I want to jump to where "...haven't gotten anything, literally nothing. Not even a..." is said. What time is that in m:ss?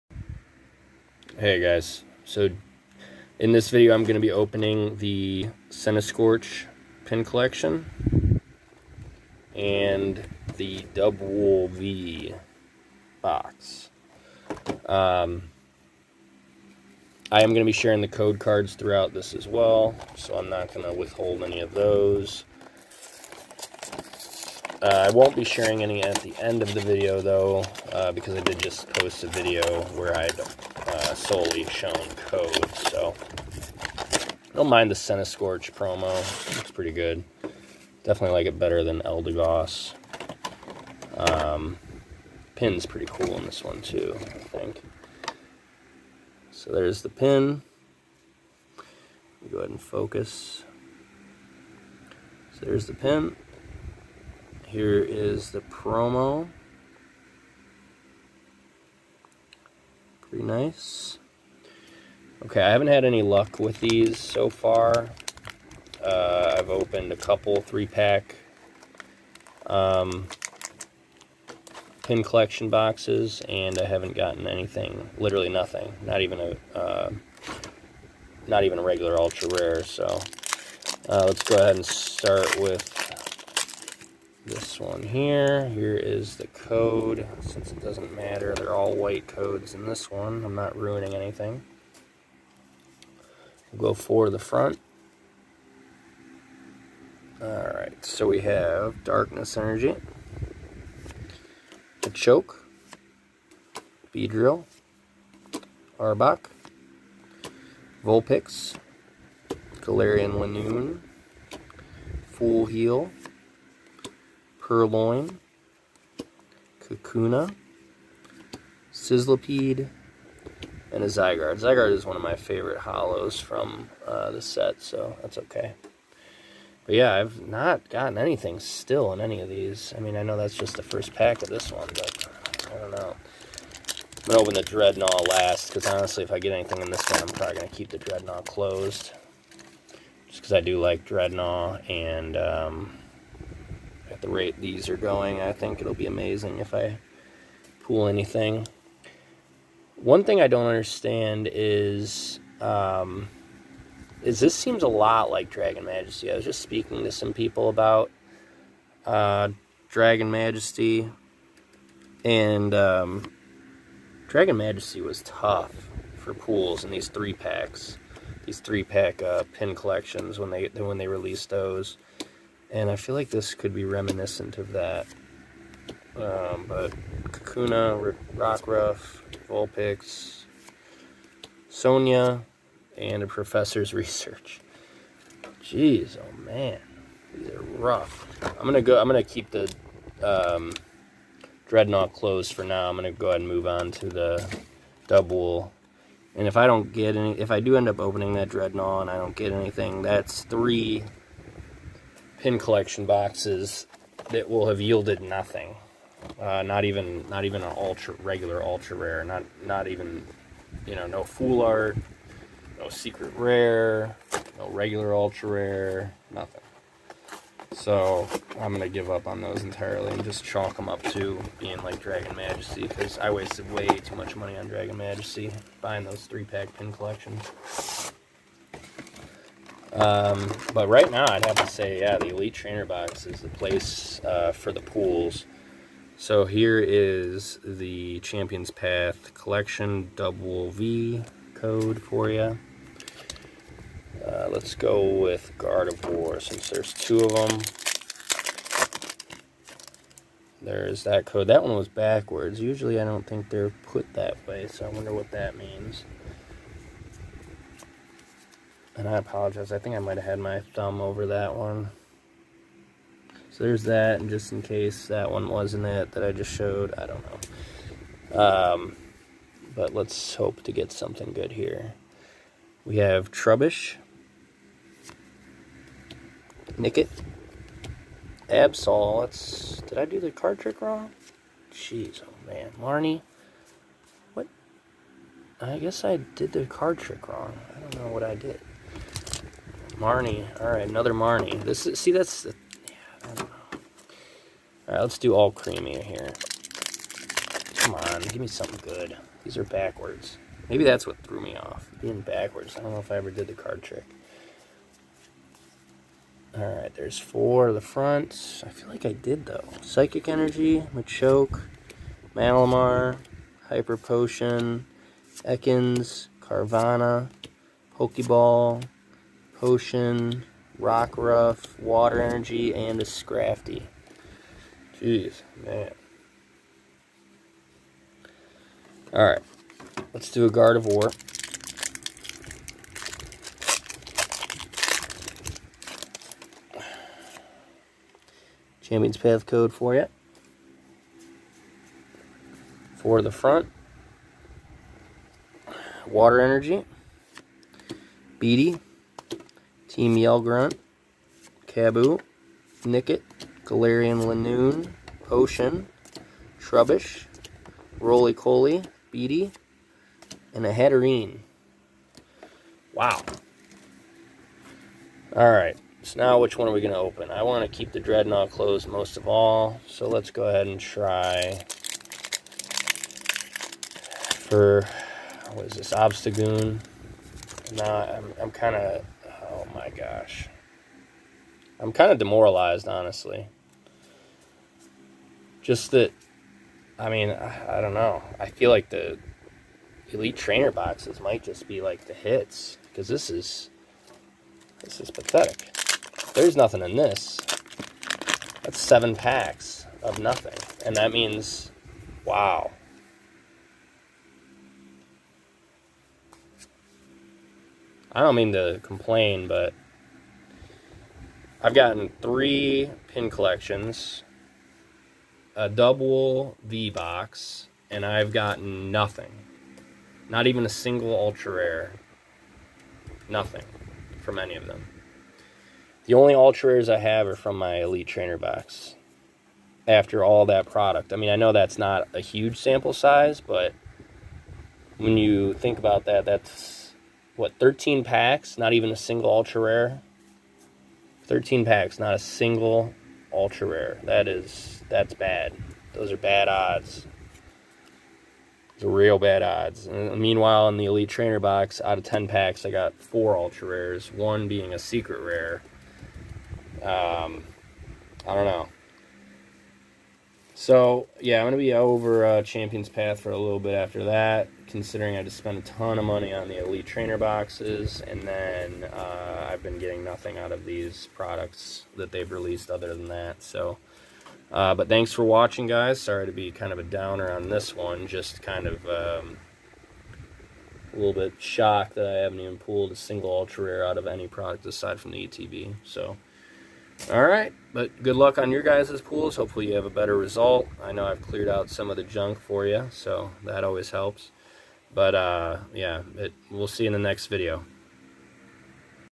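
1:13.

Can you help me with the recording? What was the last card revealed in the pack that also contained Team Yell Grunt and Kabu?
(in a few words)
Hatterene.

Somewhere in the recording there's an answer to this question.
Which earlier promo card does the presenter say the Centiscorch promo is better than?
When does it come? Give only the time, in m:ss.
0:39.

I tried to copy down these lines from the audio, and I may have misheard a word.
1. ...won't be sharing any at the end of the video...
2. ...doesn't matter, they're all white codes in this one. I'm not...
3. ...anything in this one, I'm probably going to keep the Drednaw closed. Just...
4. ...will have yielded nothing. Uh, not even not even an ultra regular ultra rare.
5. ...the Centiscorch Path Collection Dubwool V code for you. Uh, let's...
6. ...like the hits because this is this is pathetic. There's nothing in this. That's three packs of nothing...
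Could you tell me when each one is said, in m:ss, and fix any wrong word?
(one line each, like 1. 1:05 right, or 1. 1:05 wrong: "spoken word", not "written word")
1. 0:25 right
2. 1:27 right
3. 2:16 right
4. 3:24 right
5. 3:57 wrong: "Champions", not "Centiscorch"
6. 6:31 wrong: "seven", not "three".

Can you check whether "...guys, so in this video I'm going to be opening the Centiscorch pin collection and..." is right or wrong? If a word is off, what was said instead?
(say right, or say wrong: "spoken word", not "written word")
right.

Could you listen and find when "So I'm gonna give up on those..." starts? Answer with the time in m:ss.
3:37.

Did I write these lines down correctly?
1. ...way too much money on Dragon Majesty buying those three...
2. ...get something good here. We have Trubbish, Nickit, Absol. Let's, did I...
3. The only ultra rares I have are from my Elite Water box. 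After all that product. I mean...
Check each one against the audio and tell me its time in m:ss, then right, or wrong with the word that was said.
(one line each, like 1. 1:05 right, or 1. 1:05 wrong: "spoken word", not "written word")
1. 3:43 right
2. 4:30 right
3. 7:06 wrong: "Trainer", not "Water".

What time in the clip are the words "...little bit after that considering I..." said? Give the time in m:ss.
7:43.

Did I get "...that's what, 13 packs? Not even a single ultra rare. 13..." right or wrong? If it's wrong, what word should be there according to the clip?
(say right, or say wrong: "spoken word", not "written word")
right.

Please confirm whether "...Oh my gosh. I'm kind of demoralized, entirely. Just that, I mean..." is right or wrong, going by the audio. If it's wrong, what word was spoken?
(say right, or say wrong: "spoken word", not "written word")
wrong: "honestly", not "entirely".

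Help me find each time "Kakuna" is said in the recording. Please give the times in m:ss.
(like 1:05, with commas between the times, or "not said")
1:56, 2:57.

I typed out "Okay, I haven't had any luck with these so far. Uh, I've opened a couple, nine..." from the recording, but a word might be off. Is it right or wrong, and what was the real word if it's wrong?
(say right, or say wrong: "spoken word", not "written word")
wrong: "three", not "nine".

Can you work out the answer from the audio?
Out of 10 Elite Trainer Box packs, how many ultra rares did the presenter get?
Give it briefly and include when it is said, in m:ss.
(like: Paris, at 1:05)
4, at 7:33.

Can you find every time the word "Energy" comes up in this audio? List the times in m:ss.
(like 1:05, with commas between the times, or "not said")
1:39, 5:10, 5:22, 5:46.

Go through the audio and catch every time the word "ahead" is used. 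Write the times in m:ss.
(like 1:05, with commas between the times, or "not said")
0:49, 1:21, 3:13, 6:10.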